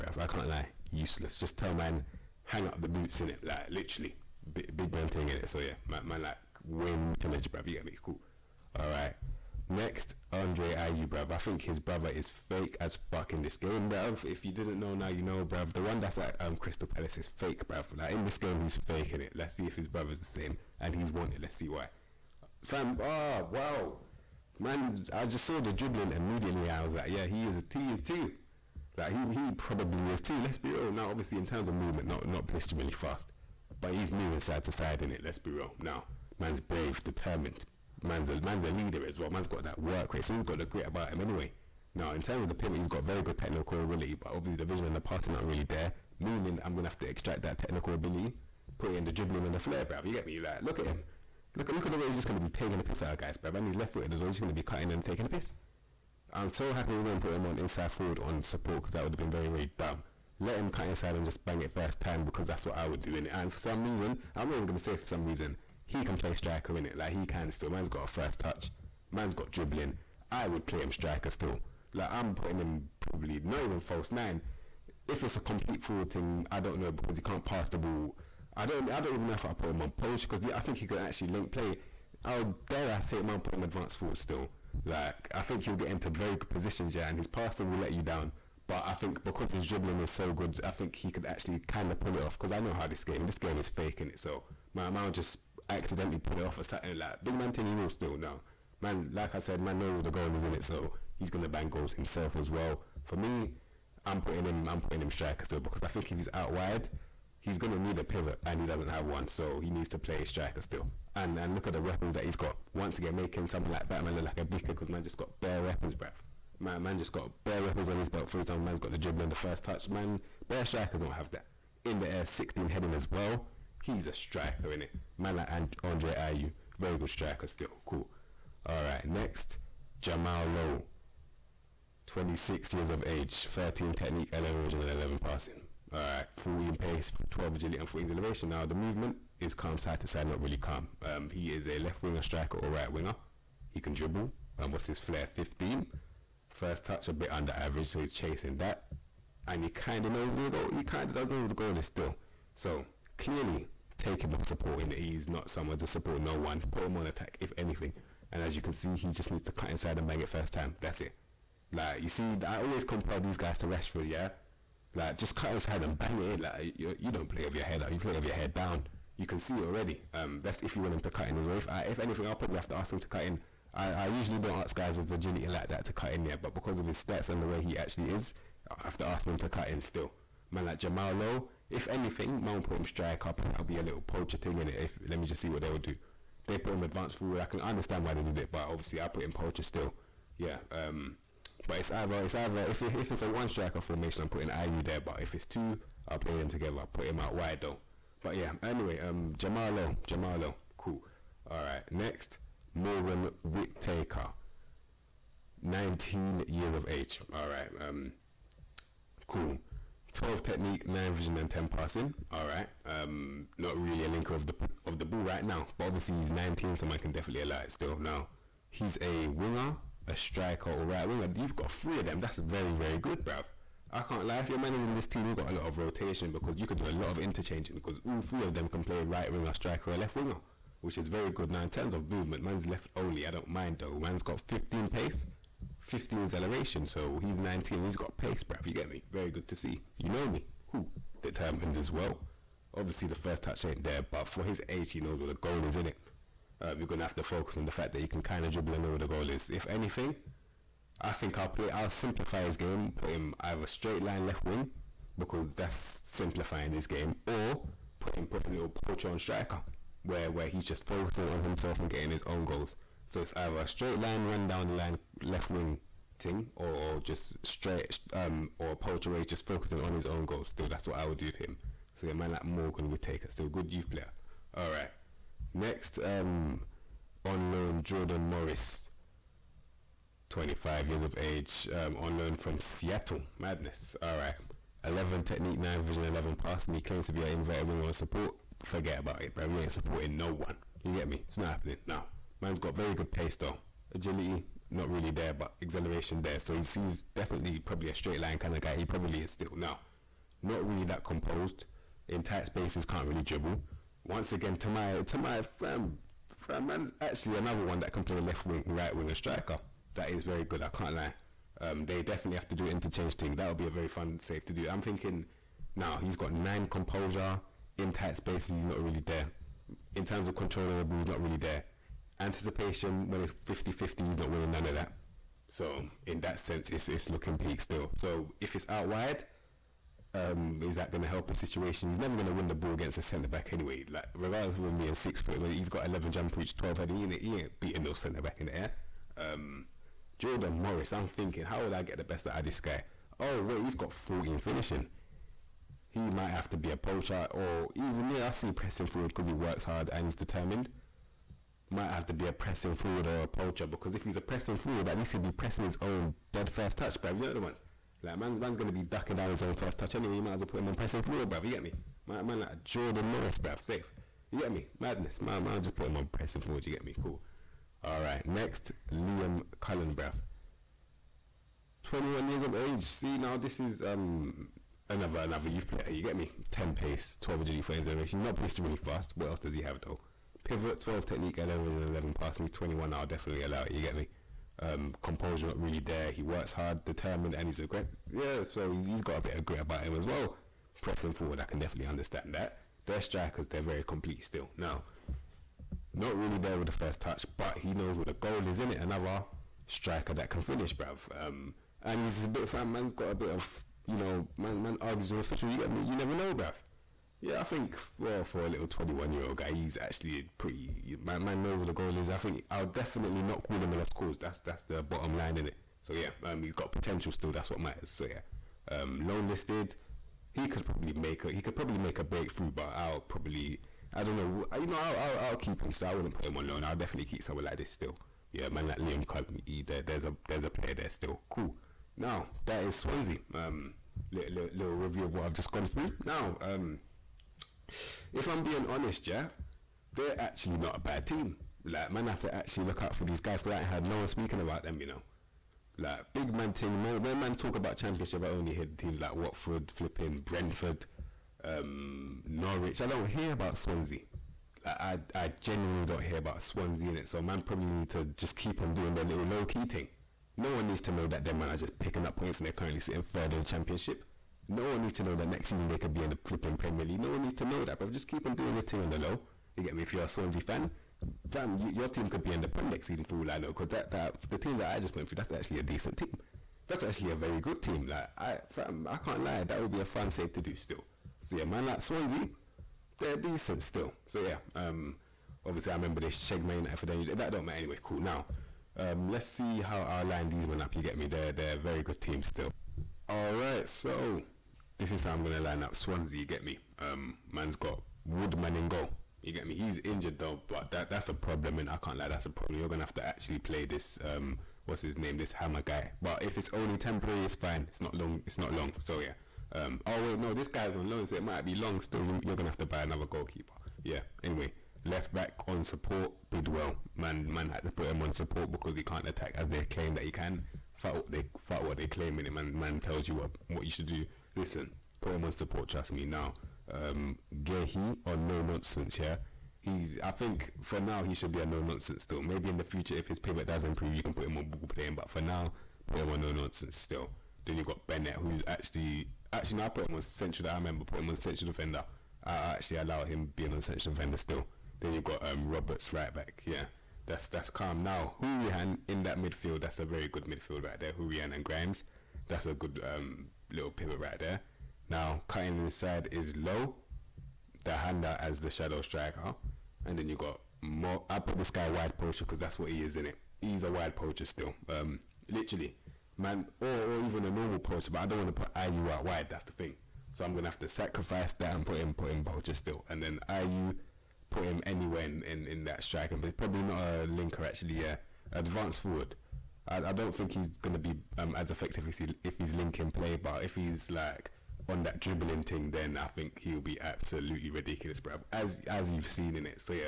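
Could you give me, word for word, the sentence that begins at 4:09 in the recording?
If anything, I think I'll play.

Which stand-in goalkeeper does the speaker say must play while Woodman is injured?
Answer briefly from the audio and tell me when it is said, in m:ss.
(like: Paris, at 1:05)
Hamer, at 8:25.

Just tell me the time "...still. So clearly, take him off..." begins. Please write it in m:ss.
2:31.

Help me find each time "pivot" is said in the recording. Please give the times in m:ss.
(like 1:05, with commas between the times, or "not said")
0:42, 1:48, 6:20, 8:53, 9:13.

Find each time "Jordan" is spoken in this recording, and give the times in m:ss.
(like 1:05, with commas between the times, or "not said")
4:37, 5:40, 6:02.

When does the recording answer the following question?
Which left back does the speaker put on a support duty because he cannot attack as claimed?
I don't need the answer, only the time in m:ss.
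8:36.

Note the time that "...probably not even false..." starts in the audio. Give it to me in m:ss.
1:12.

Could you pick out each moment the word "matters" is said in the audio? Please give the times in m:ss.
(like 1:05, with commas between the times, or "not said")
6:57, 8:07.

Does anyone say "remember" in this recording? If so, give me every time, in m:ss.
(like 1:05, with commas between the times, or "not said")
8:05, 9:00.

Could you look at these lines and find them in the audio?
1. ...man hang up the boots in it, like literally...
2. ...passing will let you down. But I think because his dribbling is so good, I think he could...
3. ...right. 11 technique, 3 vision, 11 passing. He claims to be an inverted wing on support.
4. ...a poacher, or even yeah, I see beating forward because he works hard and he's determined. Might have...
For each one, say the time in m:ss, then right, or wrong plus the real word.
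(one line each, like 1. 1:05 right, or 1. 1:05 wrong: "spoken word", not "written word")
1. 0:01 right
2. 1:27 right
3. 4:44 wrong: "9", not "3"
4. 5:46 wrong: "pressing", not "beating".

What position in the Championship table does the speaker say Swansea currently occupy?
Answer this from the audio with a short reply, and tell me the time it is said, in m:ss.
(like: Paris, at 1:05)
Third, at 7:43.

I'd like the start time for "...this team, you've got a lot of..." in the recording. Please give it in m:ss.
3:44.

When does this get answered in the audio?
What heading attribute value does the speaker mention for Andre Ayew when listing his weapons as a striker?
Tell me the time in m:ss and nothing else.
2:02.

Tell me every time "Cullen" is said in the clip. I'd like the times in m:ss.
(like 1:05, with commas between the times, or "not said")
6:09, 7:09.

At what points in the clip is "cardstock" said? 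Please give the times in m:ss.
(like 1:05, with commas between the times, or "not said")
not said.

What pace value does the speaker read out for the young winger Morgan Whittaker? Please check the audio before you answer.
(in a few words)
15.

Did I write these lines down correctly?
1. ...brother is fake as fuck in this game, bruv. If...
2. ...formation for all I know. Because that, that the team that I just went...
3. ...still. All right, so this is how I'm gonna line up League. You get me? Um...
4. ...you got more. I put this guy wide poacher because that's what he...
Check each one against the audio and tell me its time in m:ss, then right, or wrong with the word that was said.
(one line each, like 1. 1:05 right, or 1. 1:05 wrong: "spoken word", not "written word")
1. 0:11 right
2. 7:52 wrong: "season", not "formation"
3. 8:12 wrong: "Swansea", not "League"
4. 9:20 right.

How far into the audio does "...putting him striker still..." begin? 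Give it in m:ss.
1:44.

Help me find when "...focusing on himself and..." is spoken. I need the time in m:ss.
4:20.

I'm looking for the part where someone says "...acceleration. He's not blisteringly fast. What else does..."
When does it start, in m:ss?
6:17.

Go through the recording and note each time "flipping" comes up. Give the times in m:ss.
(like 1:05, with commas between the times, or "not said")
7:29, 7:46.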